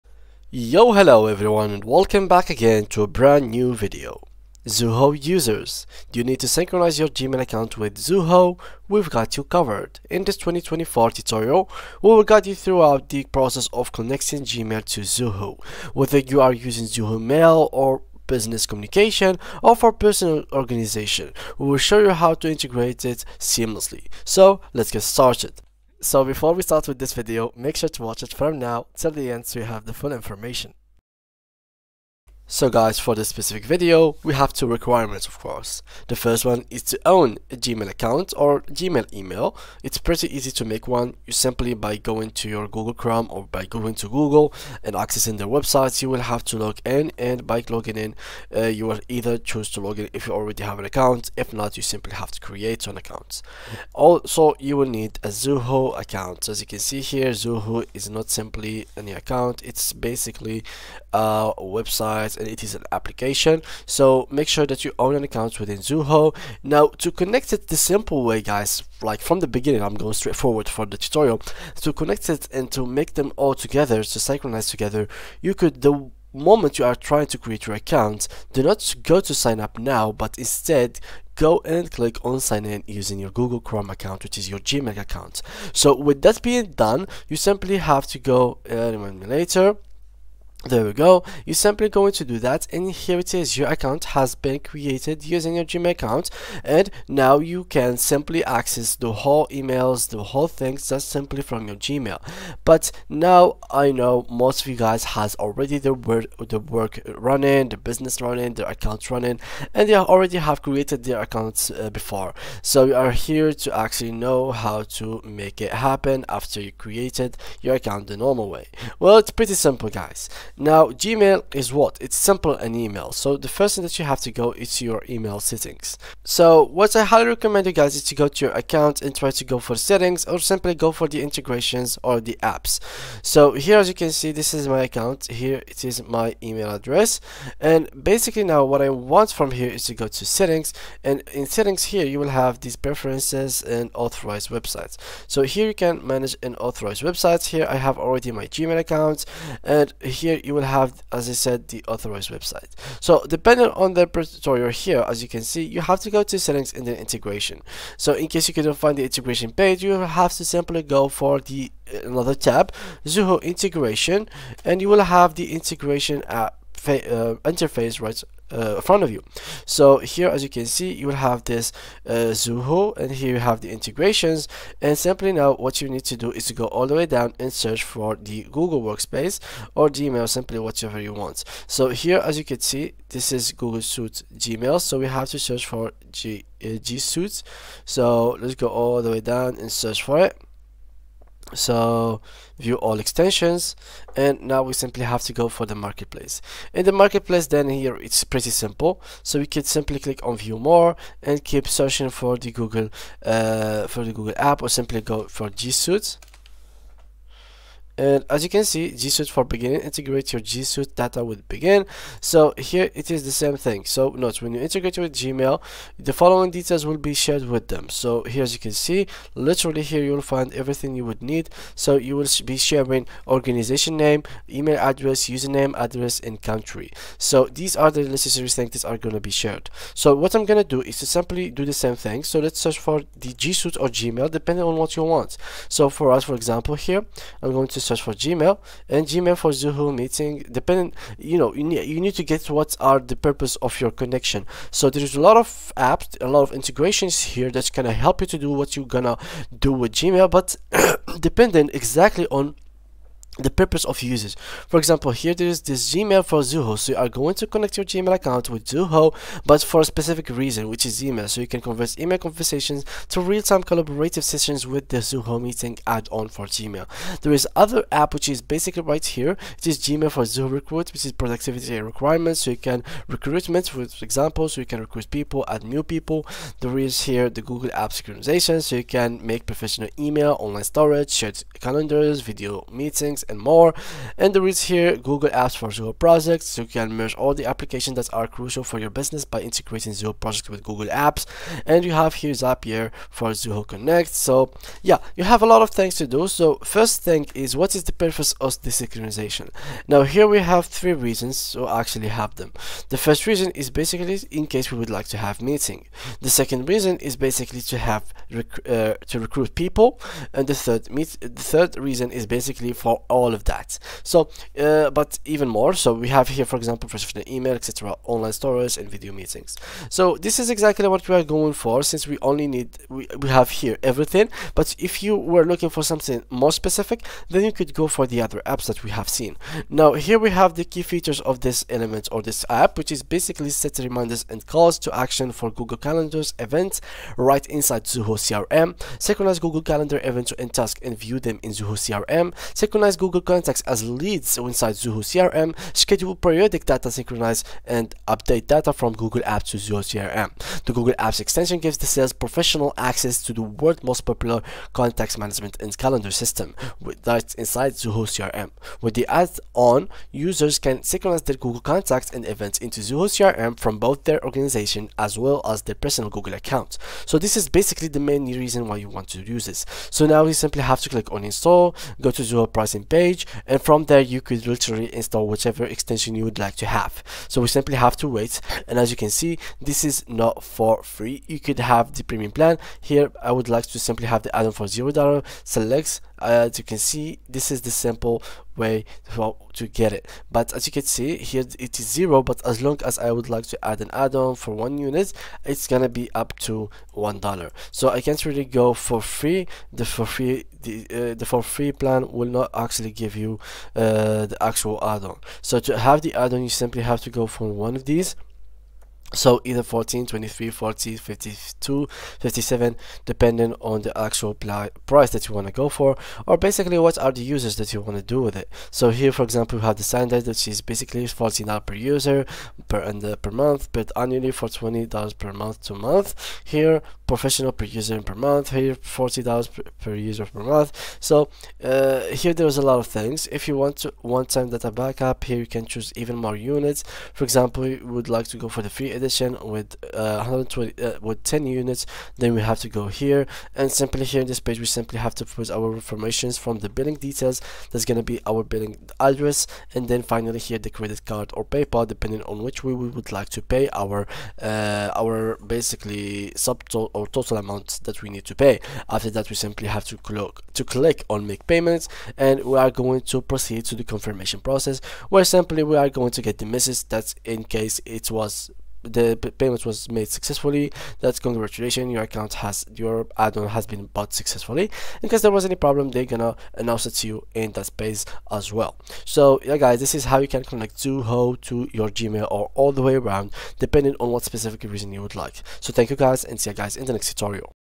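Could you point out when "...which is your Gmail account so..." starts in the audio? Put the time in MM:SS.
01:24.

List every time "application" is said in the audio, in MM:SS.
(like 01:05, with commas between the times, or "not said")
01:02, 04:47.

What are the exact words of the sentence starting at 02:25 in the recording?
So here you can manage and authorized websites.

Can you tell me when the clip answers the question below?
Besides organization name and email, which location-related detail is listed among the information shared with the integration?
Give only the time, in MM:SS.
03:46.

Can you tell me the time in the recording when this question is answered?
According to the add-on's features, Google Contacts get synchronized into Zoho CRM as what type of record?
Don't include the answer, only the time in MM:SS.
05:43.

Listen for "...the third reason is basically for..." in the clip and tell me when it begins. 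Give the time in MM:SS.
05:11.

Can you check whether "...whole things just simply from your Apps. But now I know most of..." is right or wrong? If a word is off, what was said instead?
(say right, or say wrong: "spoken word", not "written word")
wrong: "Gmail", not "Apps".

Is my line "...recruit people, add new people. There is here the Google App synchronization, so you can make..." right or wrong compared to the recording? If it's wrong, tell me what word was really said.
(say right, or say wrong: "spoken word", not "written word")
right.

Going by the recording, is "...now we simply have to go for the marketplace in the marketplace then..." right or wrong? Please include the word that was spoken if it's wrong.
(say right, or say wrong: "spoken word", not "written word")
right.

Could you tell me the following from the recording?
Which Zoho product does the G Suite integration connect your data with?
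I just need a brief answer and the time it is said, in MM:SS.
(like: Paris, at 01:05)
Bigin, at 03:31.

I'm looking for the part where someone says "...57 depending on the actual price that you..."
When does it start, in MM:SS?
06:52.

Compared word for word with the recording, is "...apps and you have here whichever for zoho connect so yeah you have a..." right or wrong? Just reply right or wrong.
wrong.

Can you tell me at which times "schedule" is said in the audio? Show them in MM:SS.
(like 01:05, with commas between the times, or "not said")
05:45.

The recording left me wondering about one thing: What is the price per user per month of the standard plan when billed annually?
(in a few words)
$14.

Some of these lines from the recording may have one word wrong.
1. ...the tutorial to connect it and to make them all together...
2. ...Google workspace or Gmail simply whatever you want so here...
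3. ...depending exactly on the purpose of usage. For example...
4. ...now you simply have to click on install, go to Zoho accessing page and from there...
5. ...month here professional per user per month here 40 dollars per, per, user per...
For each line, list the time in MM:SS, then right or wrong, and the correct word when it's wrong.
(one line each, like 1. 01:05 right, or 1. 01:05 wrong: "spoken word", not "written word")
1. 01:10 right
2. 02:58 right
3. 04:11 right
4. 06:10 wrong: "pricing", not "accessing"
5. 07:05 right.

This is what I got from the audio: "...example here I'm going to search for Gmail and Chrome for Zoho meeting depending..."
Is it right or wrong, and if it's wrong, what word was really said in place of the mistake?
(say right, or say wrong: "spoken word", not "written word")
wrong: "Gmail", not "Chrome".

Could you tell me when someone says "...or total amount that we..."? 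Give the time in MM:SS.
07:36.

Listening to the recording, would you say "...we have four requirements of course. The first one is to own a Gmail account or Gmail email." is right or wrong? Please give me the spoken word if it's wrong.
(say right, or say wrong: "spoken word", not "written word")
wrong: "two", not "four".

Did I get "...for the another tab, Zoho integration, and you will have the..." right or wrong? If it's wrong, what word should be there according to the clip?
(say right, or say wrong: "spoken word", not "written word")
right.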